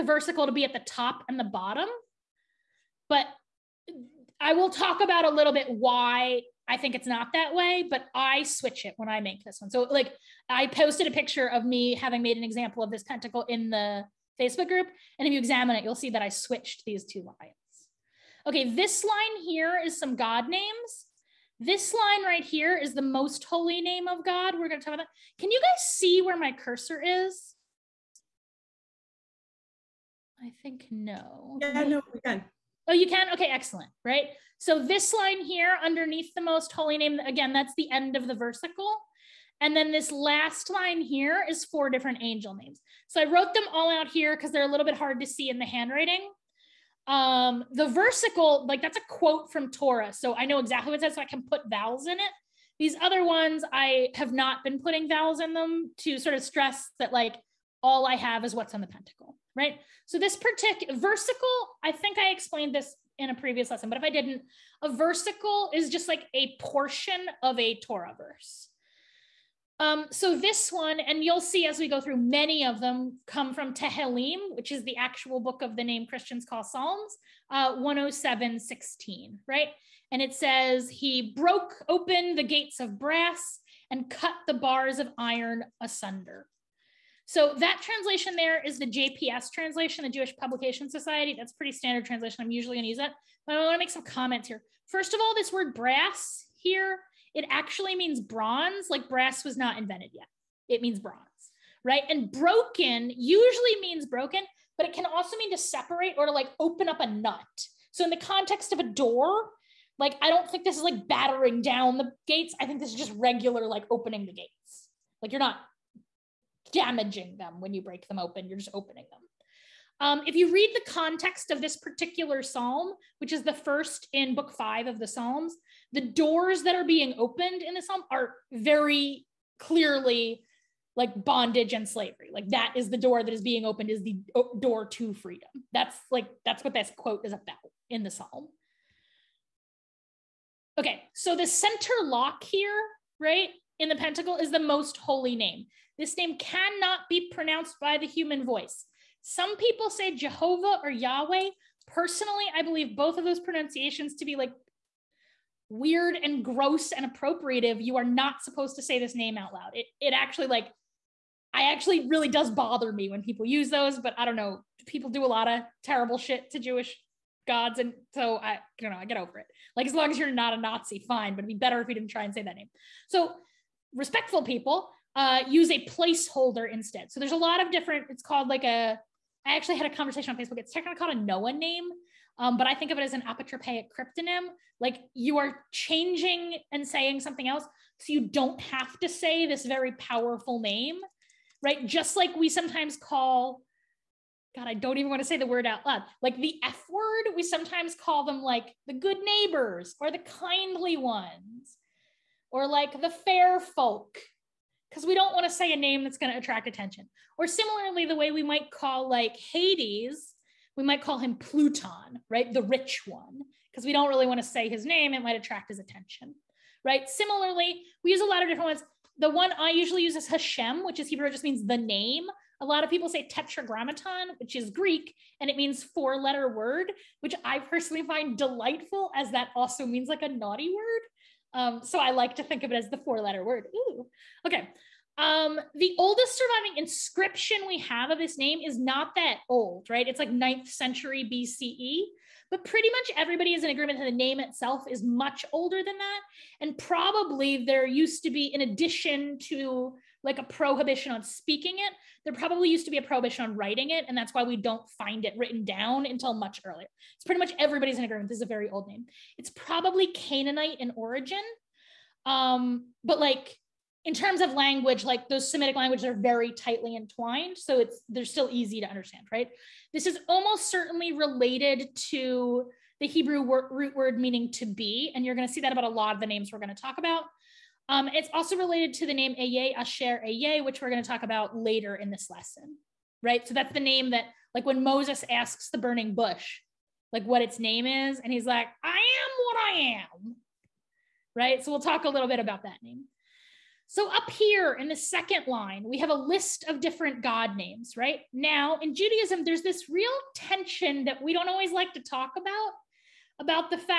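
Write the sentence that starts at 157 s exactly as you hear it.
You are not supposed to say this name out loud.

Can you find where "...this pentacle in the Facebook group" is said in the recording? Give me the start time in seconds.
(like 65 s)
12 s.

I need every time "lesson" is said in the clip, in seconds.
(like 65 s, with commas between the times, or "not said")
63 s, 282 s.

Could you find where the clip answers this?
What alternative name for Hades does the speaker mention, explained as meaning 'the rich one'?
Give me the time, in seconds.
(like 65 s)
211 s.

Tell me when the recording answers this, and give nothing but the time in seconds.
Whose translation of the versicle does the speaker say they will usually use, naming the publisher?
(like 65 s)
90 s.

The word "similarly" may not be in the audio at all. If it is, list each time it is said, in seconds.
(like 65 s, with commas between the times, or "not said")
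207 s, 217 s.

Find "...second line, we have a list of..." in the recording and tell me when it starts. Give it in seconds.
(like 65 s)
294 s.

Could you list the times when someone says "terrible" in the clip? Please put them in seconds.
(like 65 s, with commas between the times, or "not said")
165 s.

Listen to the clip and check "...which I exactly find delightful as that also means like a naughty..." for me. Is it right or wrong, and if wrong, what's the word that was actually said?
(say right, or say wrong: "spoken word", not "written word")
wrong: "personally", not "exactly".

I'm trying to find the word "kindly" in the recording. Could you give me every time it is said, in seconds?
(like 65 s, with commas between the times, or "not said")
200 s.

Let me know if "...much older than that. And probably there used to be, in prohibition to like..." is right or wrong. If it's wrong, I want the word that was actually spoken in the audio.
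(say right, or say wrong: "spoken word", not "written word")
wrong: "addition", not "prohibition".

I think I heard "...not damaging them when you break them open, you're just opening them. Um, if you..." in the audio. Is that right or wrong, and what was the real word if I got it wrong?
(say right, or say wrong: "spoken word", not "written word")
right.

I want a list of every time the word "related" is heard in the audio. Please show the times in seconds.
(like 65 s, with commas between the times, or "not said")
271 s, 278 s.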